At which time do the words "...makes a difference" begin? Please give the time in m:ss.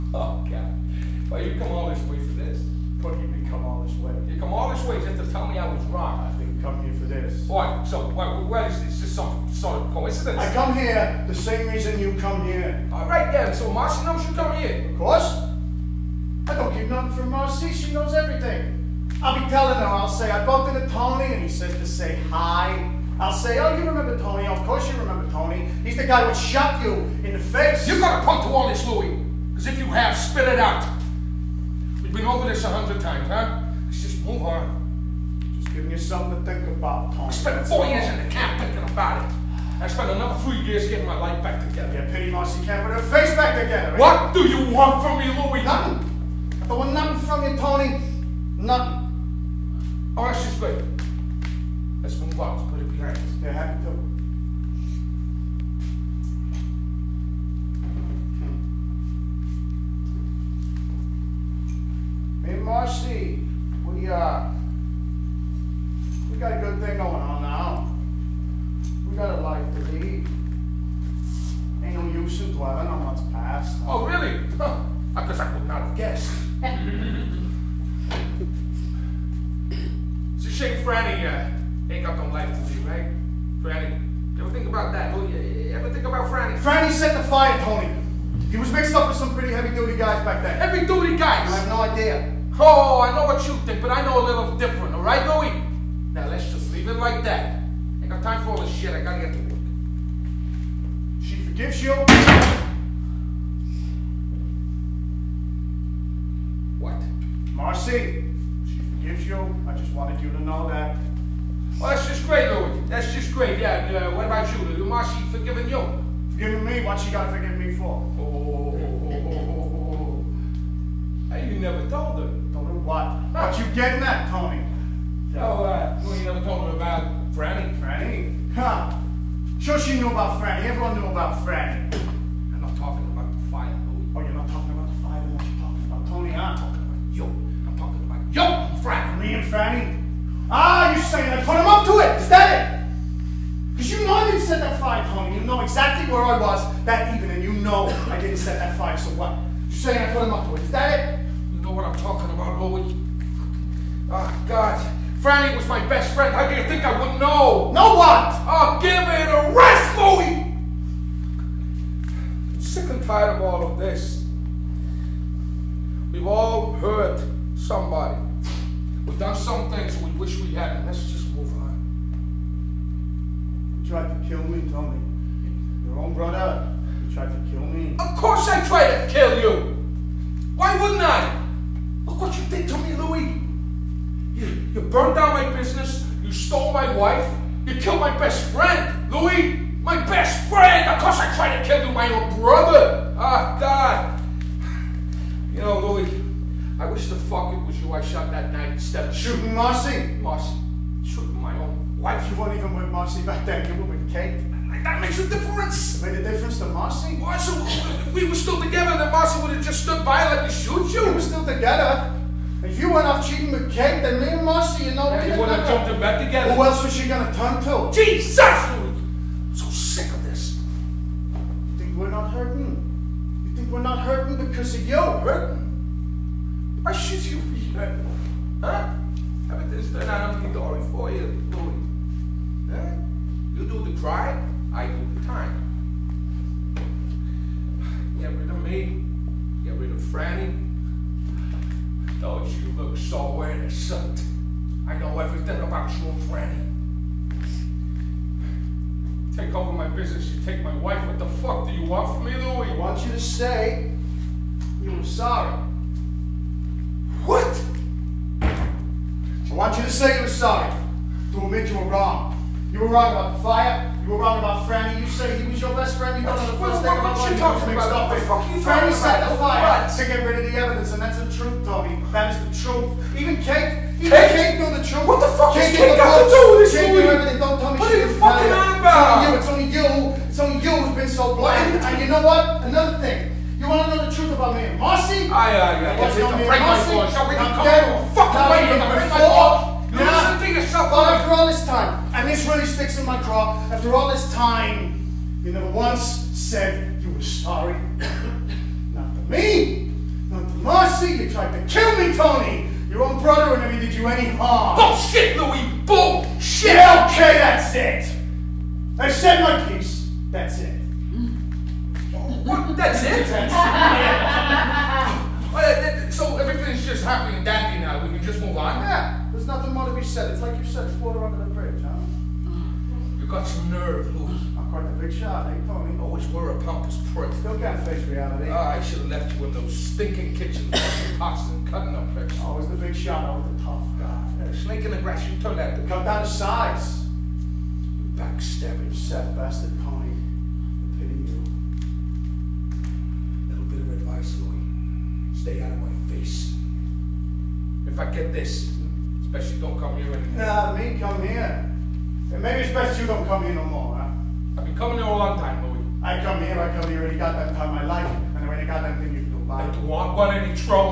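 3:25.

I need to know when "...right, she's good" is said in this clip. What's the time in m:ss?
0:50.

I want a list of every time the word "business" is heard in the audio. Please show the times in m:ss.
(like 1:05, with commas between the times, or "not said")
3:05, 4:09.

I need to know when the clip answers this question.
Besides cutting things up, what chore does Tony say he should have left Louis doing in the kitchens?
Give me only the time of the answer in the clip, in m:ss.
5:30.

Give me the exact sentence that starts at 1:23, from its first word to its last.
Franny, you ever think about that?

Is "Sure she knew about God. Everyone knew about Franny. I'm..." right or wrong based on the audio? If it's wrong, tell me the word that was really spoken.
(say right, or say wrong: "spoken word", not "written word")
wrong: "Franny", not "God".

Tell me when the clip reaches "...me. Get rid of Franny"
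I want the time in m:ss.
3:58.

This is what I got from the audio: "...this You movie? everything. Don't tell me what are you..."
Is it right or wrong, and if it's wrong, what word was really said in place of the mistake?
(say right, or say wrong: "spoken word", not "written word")
wrong: "Kate", not "You".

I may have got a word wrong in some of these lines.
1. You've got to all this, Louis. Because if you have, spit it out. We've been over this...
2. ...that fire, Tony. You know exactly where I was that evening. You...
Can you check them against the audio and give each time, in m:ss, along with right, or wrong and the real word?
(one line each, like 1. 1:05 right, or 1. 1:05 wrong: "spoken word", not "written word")
1. 0:27 right
2. 2:24 right.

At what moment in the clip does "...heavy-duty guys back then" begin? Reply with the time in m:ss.
1:29.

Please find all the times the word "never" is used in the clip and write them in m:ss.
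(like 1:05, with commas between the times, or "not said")
2:01, 2:06, 4:55, 5:03.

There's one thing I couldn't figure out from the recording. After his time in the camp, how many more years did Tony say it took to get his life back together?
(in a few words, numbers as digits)
3.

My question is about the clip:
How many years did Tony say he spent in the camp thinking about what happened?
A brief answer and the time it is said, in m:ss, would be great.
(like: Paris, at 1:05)
4, at 0:37.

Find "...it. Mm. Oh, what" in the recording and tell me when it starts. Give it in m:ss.
5:10.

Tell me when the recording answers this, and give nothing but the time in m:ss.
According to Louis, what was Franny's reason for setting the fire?
4:29.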